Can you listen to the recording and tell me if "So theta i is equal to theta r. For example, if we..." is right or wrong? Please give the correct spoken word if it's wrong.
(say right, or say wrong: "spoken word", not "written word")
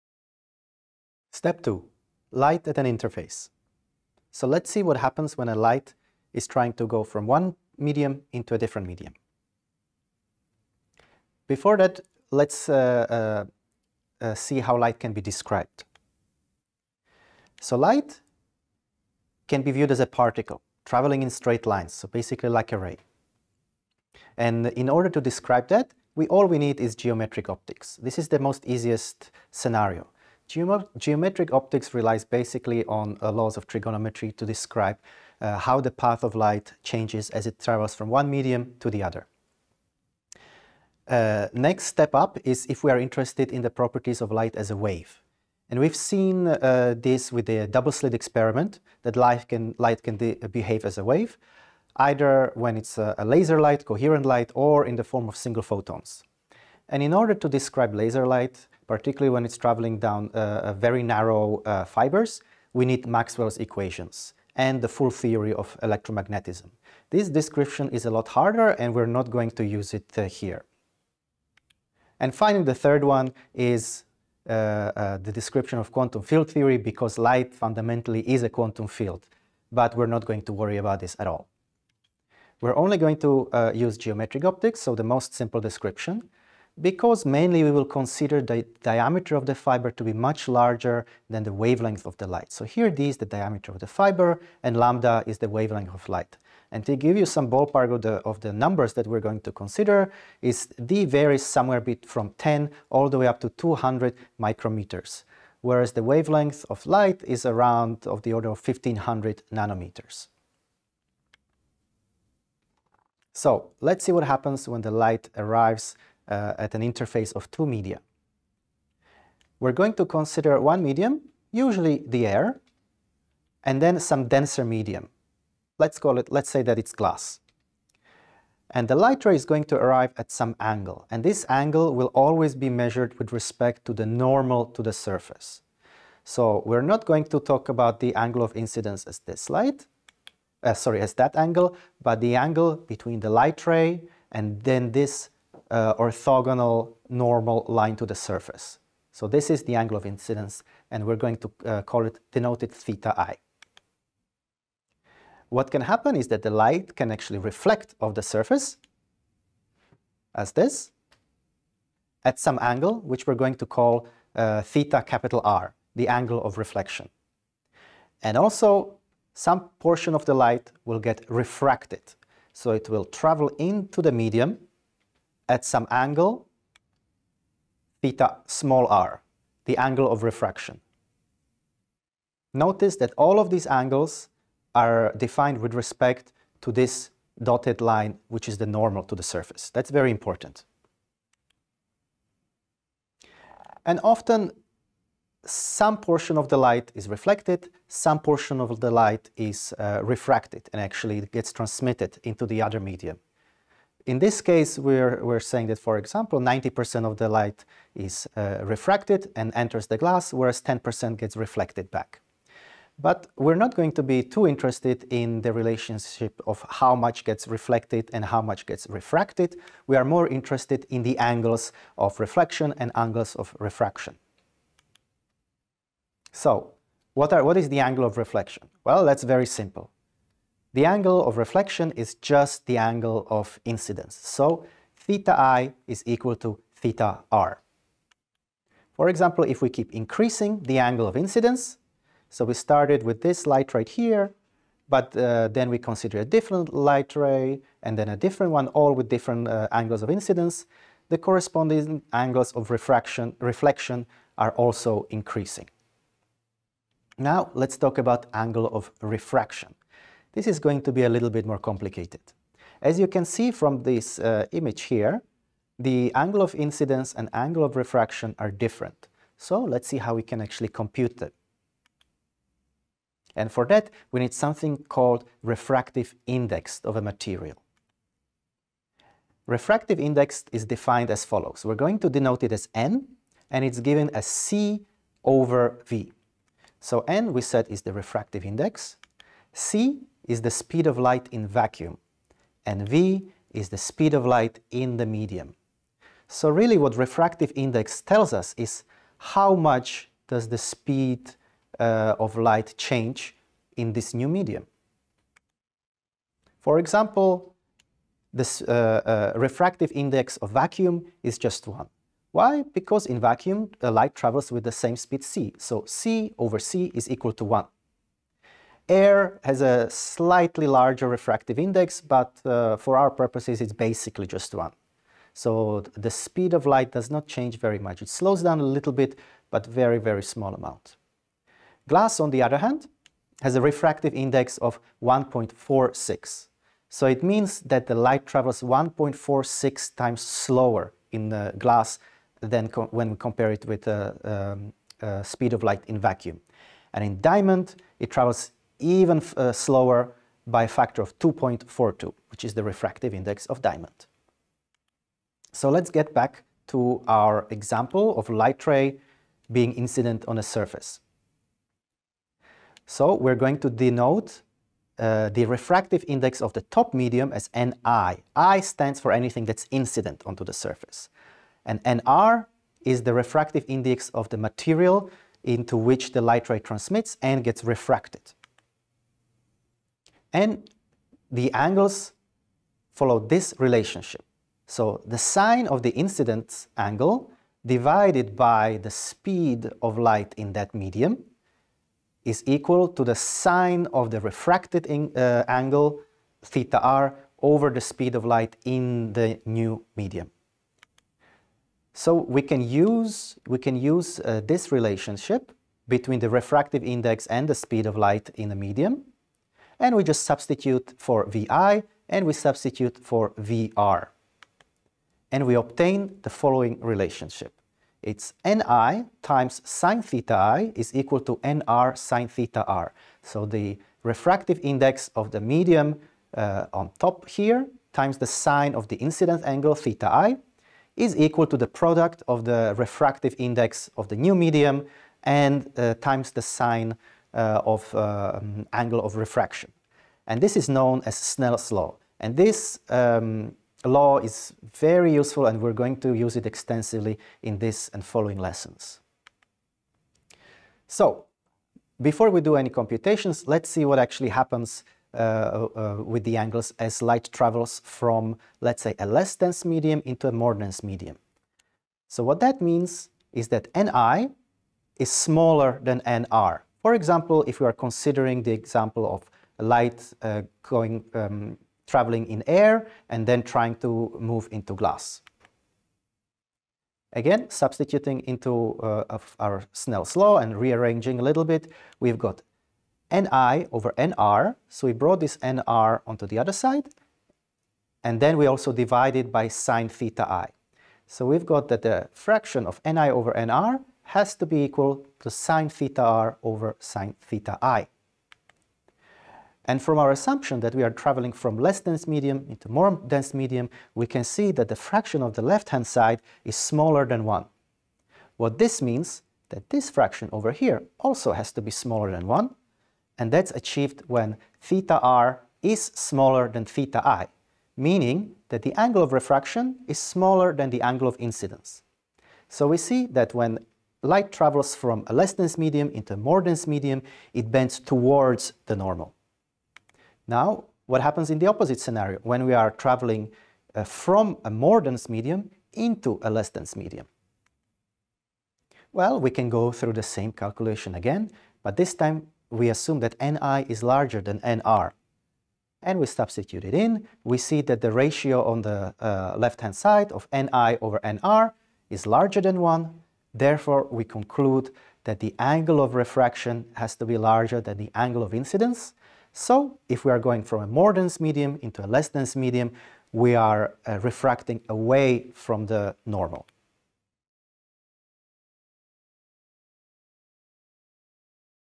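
right.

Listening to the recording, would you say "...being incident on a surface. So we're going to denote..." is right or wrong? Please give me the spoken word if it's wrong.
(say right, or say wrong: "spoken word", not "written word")
right.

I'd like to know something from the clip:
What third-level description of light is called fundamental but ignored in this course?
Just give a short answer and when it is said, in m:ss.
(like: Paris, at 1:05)
quantum field theory, at 1:15.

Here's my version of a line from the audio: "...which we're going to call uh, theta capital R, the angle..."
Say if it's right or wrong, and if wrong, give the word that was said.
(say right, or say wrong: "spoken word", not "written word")
right.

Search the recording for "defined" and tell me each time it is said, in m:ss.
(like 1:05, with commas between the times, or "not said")
3:05, 4:40.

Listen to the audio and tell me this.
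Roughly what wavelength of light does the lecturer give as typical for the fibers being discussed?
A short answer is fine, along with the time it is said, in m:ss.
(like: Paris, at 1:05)
1500 nanometers, at 1:48.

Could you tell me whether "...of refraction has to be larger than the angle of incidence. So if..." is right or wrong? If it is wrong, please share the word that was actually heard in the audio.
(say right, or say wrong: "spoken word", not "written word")
right.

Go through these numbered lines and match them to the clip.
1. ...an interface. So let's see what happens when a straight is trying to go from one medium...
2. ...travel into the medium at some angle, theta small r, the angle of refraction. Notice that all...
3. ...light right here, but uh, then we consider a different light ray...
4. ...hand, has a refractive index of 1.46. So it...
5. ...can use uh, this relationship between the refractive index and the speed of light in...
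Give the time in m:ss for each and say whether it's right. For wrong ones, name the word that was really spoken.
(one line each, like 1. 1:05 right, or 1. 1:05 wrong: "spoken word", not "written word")
1. 0:02 wrong: "light", not "straight"
2. 2:53 right
3. 4:03 right
4. 5:32 right
5. 6:43 right.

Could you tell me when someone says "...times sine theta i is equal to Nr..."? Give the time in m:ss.
6:59.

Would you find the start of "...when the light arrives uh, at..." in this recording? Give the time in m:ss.
1:54.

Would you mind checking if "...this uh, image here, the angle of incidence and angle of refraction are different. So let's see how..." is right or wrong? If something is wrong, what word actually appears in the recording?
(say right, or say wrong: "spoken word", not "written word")
right.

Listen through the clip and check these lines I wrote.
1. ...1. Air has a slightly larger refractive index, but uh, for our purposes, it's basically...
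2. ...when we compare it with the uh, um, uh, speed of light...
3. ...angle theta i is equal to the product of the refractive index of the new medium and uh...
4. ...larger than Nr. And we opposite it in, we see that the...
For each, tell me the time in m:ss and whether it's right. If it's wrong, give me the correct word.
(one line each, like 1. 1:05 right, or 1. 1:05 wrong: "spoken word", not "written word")
1. 5:17 right
2. 5:42 right
3. 7:09 right
4. 9:03 wrong: "substitute", not "opposite".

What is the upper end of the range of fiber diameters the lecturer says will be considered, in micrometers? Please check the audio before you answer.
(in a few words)
200 micrometers.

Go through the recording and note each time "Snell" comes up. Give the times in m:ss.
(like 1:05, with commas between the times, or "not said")
7:21, 7:59.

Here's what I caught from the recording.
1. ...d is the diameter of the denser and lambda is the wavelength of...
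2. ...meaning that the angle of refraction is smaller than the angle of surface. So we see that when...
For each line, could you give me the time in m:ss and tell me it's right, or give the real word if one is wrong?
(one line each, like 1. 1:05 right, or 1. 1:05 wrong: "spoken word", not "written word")
1. 1:32 wrong: "fiber", not "denser"
2. 8:37 wrong: "incidence", not "surface".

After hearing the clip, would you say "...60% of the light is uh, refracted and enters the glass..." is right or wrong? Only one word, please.
wrong.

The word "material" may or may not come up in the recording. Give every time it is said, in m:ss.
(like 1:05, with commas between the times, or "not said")
4:37, 6:14.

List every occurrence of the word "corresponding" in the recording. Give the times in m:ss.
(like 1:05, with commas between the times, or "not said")
4:11.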